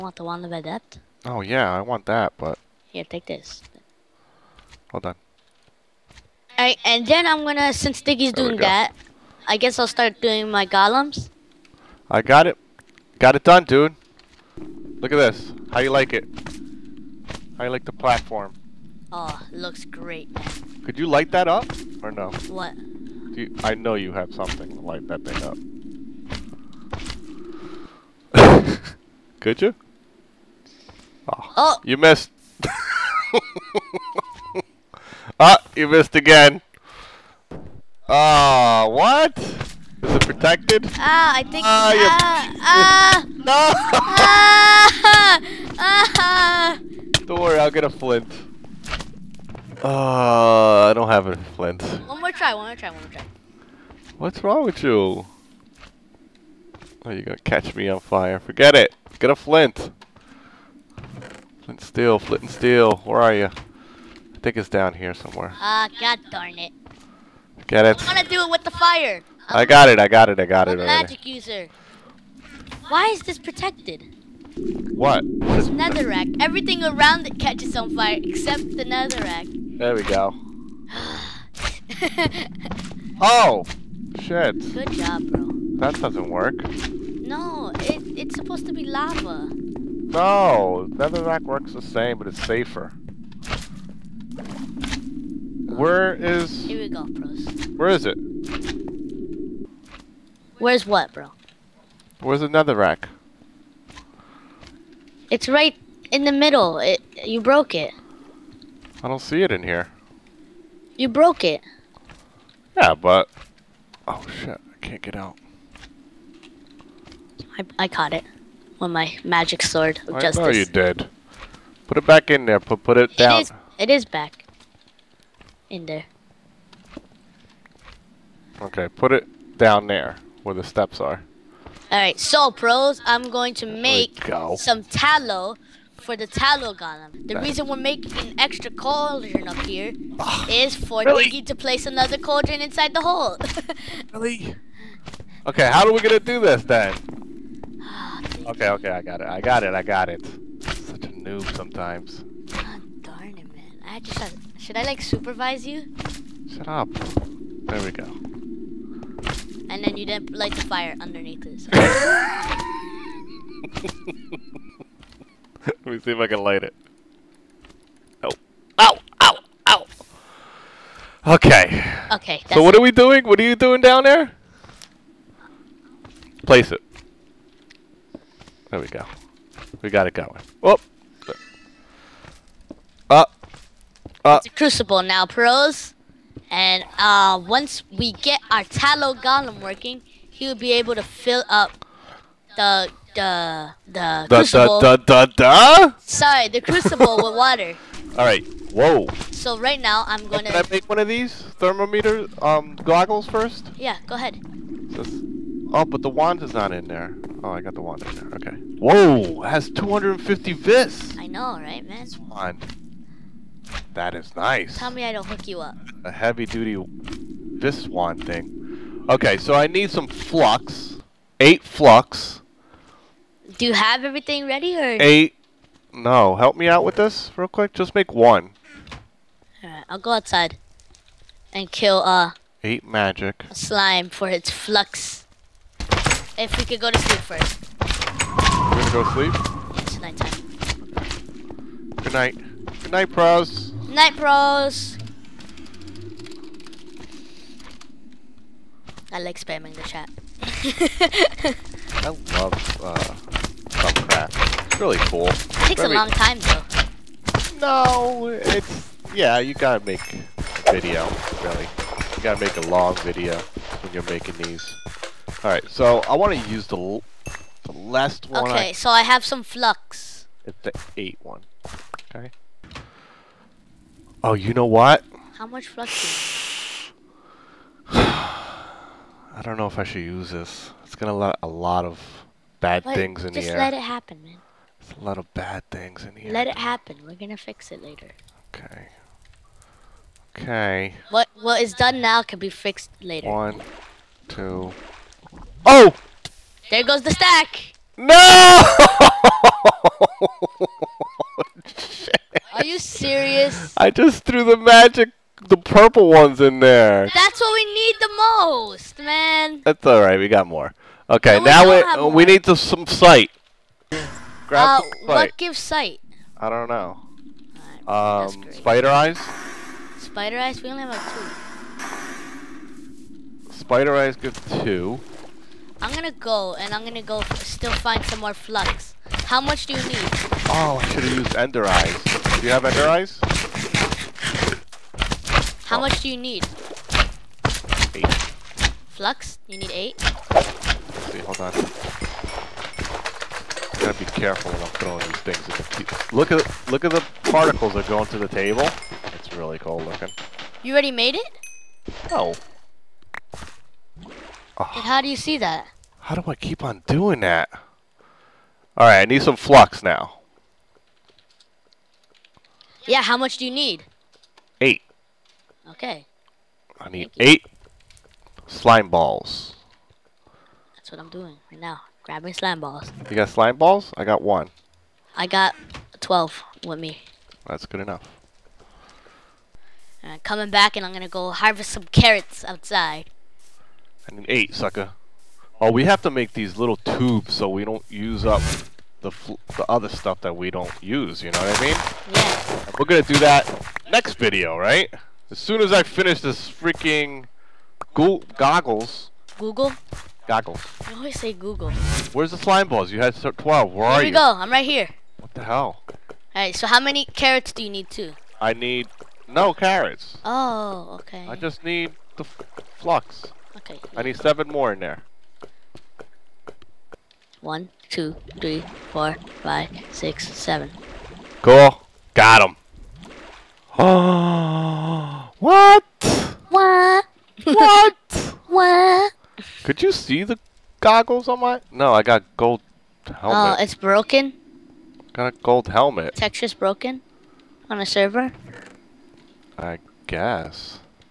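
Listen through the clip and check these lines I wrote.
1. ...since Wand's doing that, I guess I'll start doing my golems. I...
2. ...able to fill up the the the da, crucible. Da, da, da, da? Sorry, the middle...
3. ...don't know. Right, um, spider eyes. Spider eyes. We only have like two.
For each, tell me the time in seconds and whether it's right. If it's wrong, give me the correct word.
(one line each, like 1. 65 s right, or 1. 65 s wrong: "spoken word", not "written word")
1. 7 s wrong: "Diggy", not "Wand"
2. 190 s wrong: "crucible", not "middle"
3. 316 s right.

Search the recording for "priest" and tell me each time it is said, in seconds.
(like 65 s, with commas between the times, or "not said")
not said.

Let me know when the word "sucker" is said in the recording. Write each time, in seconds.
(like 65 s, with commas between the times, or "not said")
384 s.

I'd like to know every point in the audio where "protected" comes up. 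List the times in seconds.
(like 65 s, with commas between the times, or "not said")
40 s, 73 s.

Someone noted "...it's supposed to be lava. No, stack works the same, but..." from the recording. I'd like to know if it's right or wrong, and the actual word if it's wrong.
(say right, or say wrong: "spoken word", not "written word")
wrong: "netherrack", not "stack".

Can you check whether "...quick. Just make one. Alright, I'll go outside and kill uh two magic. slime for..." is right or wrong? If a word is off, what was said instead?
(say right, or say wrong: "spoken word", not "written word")
wrong: "eight", not "two".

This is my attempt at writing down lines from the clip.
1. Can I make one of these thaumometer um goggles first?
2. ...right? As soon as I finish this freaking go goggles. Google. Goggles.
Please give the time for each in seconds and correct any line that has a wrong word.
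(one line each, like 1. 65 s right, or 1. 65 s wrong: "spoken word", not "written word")
1. 200 s right
2. 394 s right.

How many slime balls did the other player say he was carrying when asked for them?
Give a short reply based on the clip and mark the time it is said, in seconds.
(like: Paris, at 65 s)
12, at 375 s.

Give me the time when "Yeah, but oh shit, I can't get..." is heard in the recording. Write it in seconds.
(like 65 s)
112 s.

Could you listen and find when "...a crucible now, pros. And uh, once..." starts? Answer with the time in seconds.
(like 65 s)
184 s.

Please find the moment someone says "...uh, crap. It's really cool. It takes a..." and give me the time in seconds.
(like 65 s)
252 s.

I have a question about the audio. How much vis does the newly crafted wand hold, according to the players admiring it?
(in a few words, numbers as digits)
250.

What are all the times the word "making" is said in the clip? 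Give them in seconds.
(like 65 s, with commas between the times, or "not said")
137 s, 264 s.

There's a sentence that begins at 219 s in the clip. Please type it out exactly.
Okay, so I need some flux.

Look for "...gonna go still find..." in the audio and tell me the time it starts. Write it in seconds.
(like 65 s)
326 s.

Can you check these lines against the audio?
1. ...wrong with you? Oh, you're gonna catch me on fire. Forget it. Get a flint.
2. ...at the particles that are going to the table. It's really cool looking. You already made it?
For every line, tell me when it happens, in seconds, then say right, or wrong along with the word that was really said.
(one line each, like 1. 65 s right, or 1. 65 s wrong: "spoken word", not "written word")
1. 54 s right
2. 346 s right.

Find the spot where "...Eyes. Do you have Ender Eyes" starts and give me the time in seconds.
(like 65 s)
331 s.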